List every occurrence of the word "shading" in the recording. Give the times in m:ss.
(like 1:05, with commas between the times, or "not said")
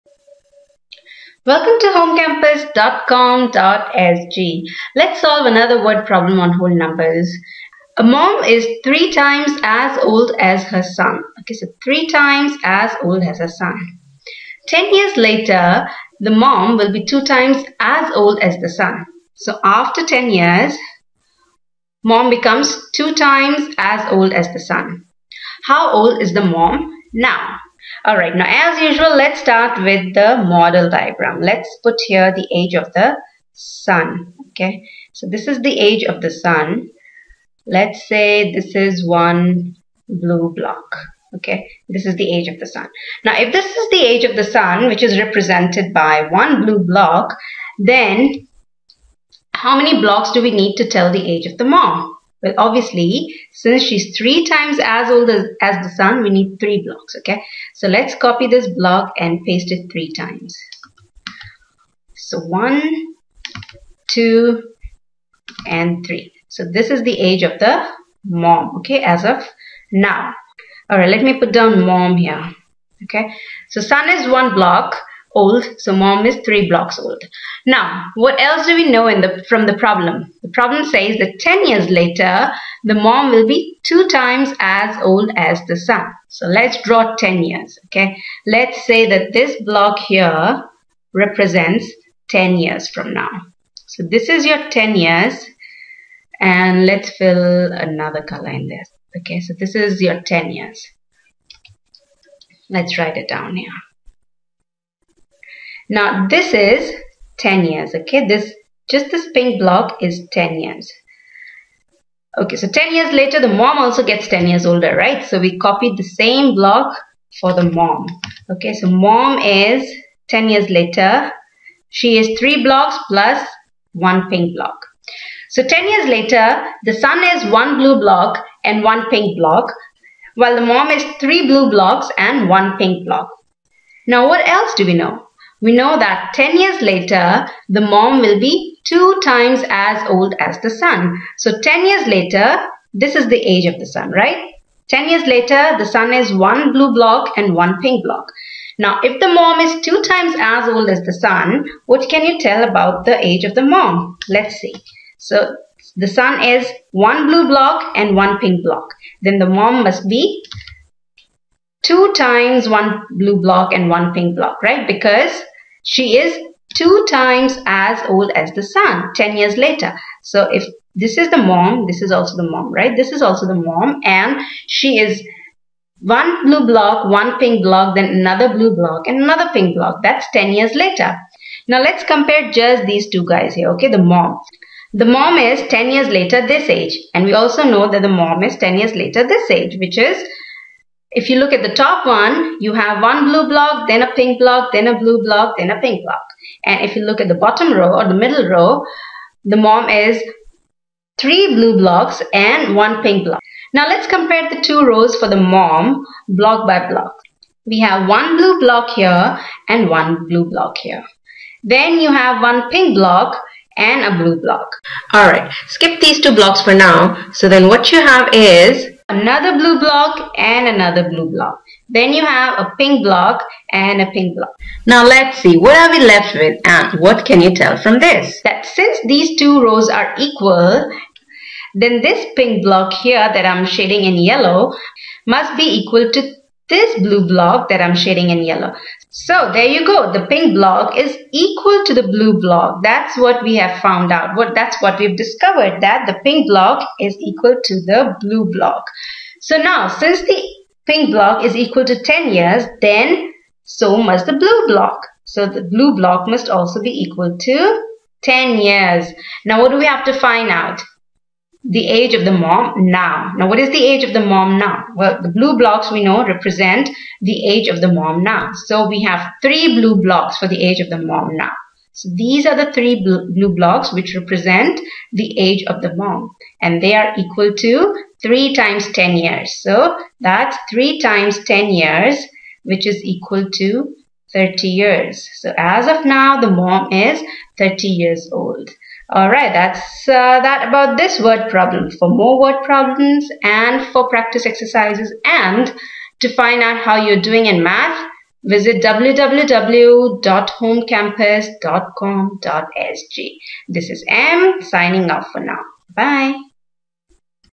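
3:53, 3:57.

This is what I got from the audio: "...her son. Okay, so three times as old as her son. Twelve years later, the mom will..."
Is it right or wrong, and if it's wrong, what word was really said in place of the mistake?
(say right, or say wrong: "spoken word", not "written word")
wrong: "Ten", not "Twelve".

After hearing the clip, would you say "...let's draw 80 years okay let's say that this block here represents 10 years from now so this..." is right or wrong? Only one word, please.
wrong.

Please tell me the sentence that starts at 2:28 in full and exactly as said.
Now, if the mom is two times as old as the son, what can you tell about the age of the mom?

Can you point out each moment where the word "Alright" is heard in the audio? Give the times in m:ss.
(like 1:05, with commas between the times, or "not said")
3:35, 4:49.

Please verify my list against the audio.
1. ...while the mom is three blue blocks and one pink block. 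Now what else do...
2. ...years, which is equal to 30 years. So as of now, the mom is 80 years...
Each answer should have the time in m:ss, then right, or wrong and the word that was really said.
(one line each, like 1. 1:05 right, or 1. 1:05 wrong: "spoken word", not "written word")
1. 2:10 right
2. 4:41 wrong: "30", not "80".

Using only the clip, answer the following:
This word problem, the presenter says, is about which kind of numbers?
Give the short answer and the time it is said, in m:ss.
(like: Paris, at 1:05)
whole numbers, at 0:06.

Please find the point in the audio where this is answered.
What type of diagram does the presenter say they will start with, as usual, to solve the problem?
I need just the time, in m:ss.
0:30.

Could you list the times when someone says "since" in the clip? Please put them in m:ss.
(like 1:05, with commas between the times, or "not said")
0:53, 3:48, 4:09.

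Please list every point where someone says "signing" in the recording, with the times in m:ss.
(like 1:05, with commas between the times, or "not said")
5:04.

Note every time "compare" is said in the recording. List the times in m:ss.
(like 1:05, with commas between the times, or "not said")
3:02, 3:24.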